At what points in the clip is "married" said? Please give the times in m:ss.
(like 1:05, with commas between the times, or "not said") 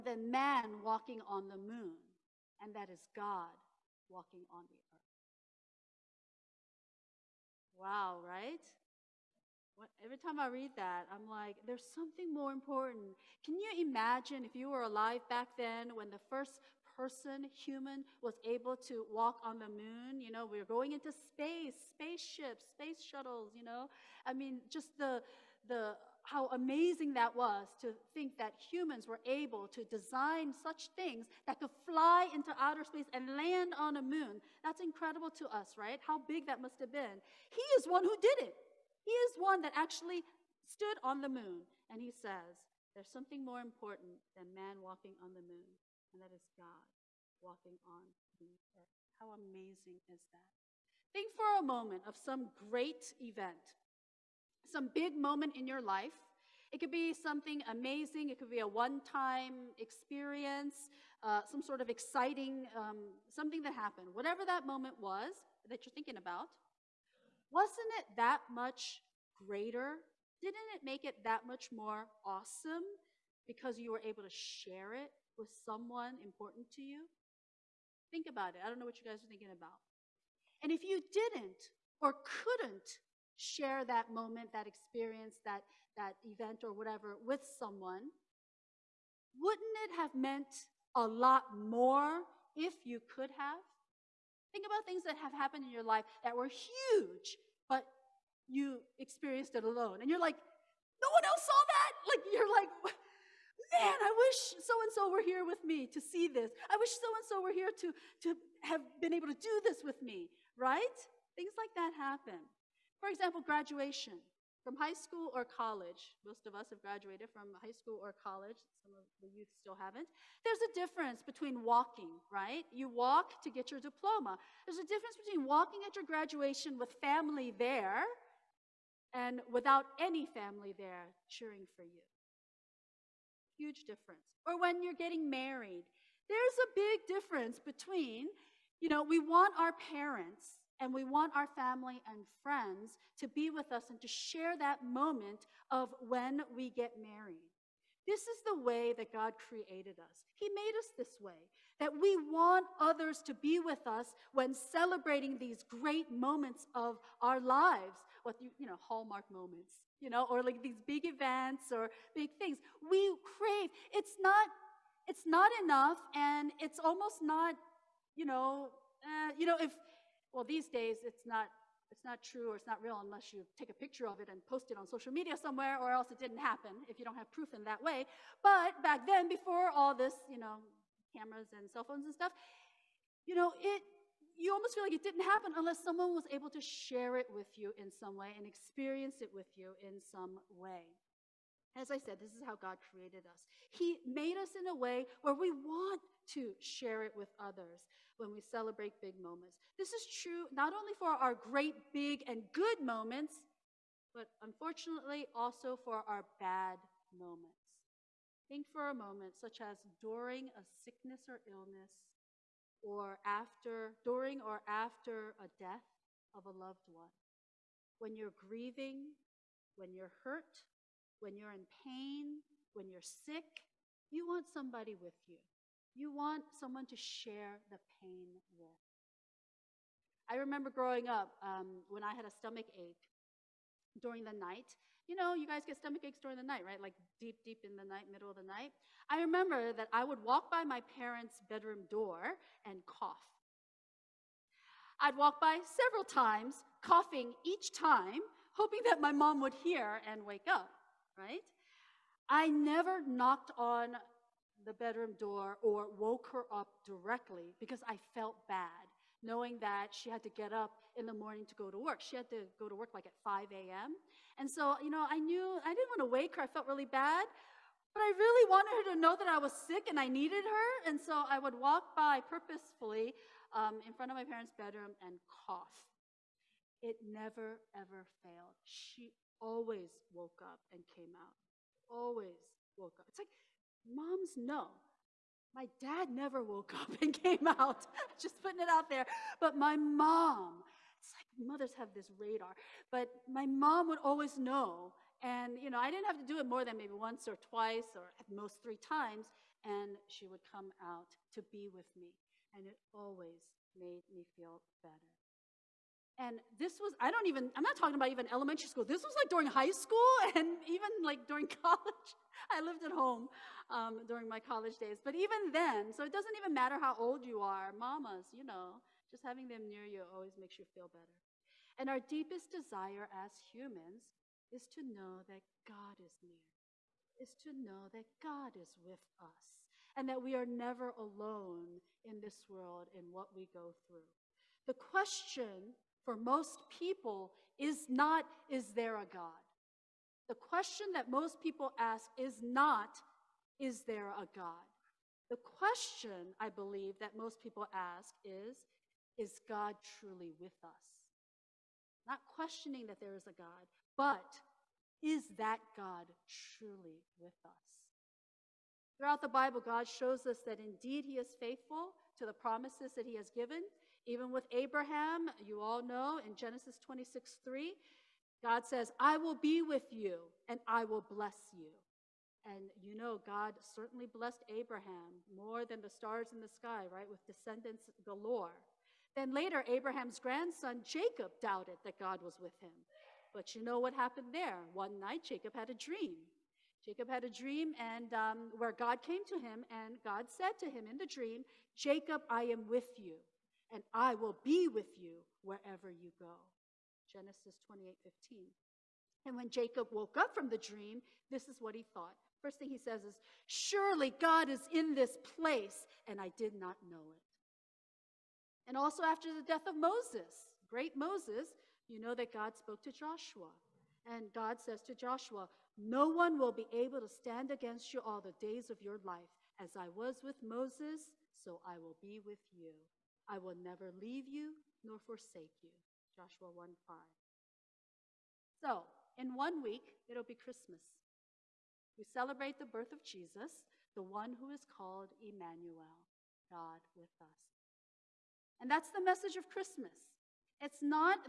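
2:15, 2:27.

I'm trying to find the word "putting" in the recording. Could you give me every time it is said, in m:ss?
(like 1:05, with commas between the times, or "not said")
4:48.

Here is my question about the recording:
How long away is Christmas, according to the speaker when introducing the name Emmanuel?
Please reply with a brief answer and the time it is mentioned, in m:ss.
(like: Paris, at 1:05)
one week, at 7:09.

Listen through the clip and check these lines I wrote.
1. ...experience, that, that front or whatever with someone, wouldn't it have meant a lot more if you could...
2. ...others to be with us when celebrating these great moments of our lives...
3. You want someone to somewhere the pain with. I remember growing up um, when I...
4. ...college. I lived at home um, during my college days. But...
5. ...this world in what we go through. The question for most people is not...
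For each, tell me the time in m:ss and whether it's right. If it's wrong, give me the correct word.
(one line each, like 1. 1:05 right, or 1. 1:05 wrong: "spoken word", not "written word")
1. 1:24 wrong: "event", not "front"
2. 2:32 right
3. 3:45 wrong: "share", not "somewhere"
4. 5:11 right
5. 5:32 right.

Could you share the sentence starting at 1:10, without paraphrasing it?
Didn't it make it that much more awesome because you were able to share it with someone important to you?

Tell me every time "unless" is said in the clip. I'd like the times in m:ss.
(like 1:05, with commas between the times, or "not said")
2:53, 3:05.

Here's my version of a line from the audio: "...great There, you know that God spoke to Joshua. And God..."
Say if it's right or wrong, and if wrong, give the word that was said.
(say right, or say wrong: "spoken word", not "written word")
wrong: "Moses", not "There".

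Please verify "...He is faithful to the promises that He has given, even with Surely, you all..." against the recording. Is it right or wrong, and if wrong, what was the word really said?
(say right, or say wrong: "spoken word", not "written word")
wrong: "Abraham", not "Surely".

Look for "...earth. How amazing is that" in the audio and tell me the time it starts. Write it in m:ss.
0:48.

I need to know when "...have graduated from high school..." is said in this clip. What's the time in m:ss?
1:56.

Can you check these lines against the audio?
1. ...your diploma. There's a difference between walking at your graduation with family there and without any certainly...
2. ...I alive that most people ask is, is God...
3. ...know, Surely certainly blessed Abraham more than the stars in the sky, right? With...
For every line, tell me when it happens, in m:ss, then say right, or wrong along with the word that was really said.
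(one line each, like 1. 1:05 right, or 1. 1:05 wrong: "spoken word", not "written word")
1. 2:03 wrong: "family", not "certainly"
2. 5:46 wrong: "believe", not "alive"
3. 6:12 wrong: "God", not "Surely".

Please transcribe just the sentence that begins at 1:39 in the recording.
And you're like, no one else saw that.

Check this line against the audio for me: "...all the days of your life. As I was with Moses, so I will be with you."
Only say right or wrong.
right.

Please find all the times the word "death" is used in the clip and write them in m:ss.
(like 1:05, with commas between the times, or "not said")
3:35, 6:49.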